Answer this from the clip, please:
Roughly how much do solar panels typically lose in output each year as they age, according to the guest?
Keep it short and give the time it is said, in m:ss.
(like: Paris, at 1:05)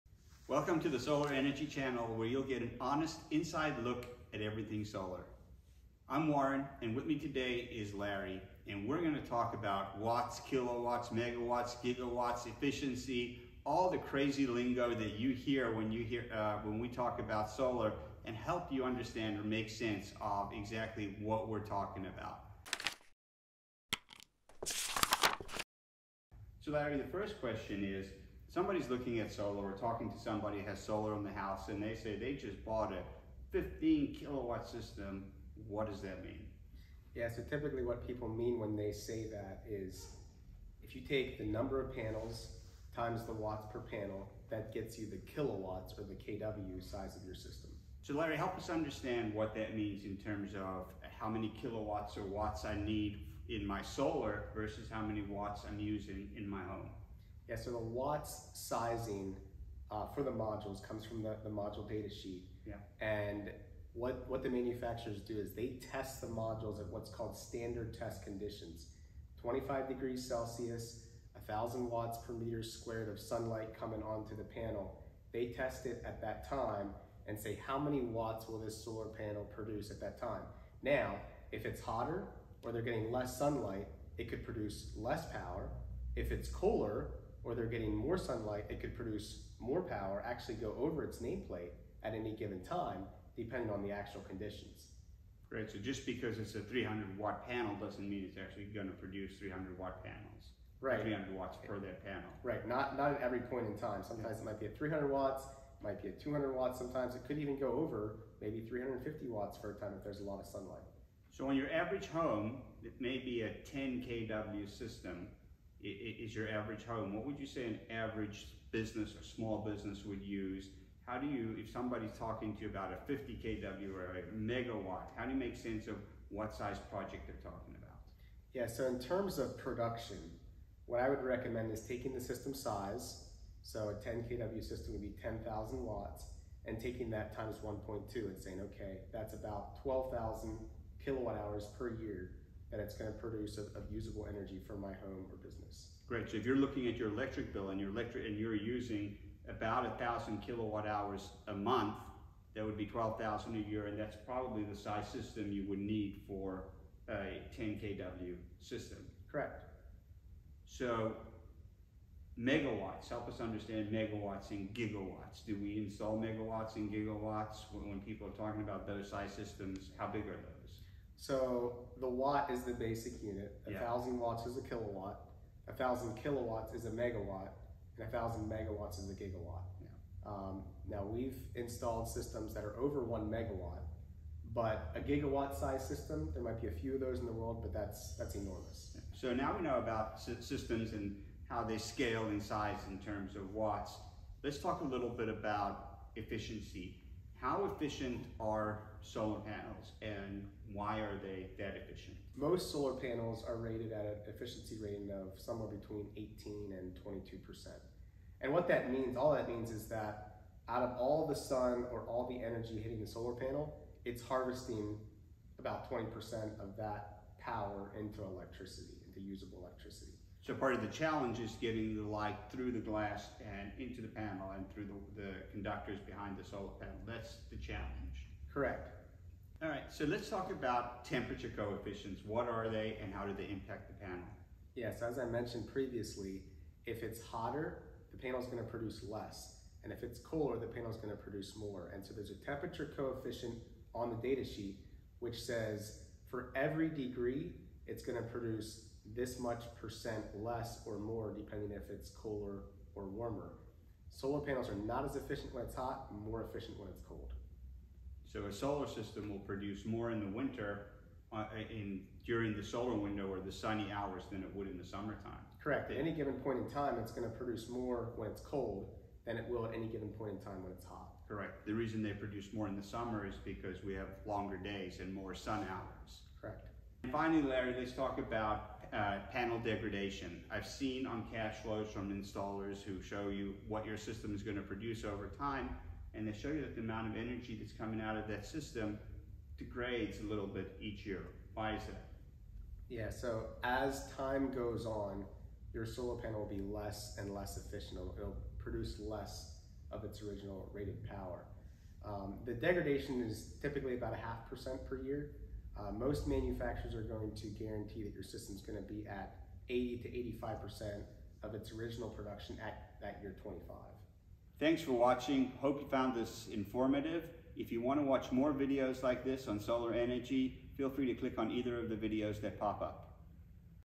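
half percent, at 5:04.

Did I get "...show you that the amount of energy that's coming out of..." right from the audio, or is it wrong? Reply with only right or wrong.
right.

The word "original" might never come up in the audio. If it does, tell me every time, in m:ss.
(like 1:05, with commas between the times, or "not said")
5:00, 5:11.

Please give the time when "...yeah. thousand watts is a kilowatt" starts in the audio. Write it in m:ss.
2:53.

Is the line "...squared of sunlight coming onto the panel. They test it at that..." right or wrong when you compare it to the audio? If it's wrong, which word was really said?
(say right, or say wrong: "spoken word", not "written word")
right.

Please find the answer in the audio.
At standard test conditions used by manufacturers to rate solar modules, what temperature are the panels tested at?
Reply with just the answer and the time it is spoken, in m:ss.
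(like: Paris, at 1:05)
25 degrees Celsius, at 1:09.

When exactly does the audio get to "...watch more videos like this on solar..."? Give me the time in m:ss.
5:18.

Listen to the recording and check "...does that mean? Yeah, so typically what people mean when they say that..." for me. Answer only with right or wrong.
right.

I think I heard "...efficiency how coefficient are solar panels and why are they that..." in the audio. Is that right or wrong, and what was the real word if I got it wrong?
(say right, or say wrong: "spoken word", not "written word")
wrong: "efficient", not "coefficient".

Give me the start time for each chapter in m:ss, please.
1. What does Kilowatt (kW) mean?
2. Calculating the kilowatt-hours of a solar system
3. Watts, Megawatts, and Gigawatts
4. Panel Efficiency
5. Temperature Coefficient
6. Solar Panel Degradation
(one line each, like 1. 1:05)
1. 0:26
2. 1:52
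3. 2:41
4. 3:14
5. 3:50
6. 4:37.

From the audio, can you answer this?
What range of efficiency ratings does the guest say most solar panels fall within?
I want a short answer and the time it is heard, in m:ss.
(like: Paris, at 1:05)
18 to 22%, at 3:25.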